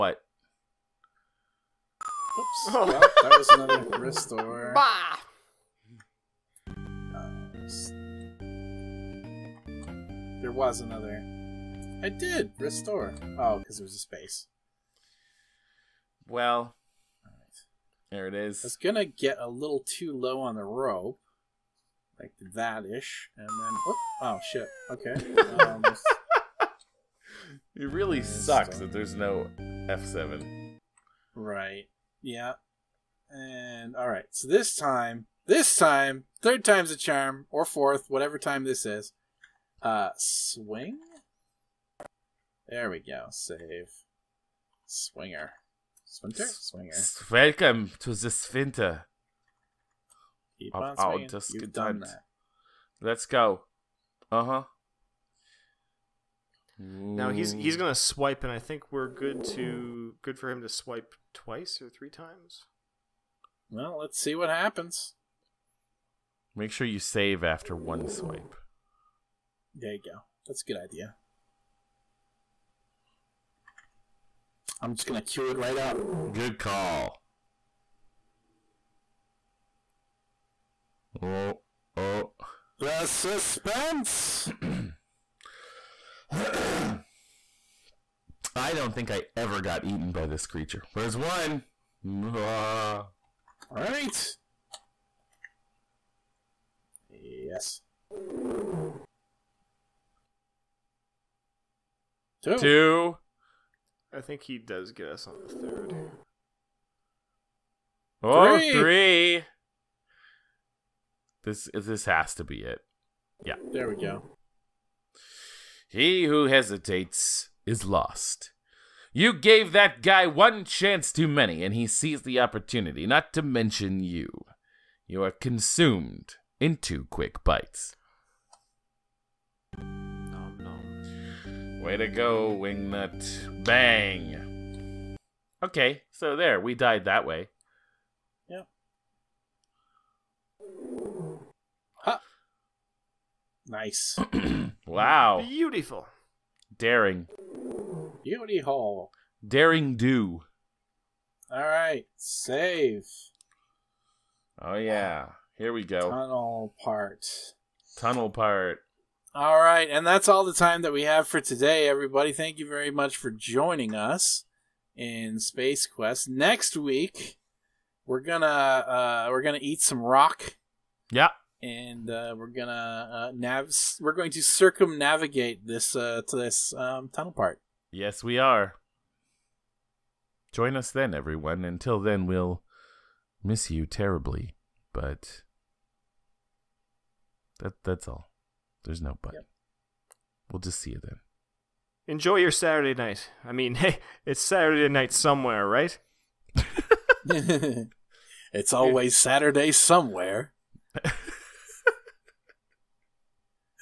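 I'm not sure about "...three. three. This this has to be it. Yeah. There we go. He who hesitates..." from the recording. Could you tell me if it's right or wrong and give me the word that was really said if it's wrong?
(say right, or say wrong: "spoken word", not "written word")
right.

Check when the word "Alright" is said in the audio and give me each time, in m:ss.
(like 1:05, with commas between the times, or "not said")
2:31.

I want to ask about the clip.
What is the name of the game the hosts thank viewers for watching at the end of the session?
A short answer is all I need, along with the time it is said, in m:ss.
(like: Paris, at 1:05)
Space Quest, at 2:45.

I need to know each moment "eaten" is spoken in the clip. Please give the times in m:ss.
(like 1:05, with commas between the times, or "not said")
1:29.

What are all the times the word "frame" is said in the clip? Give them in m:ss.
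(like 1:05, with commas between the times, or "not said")
not said.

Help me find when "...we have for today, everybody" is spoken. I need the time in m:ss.
2:40.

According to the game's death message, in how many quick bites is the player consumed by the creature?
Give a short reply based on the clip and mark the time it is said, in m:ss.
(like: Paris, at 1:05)
2, at 2:06.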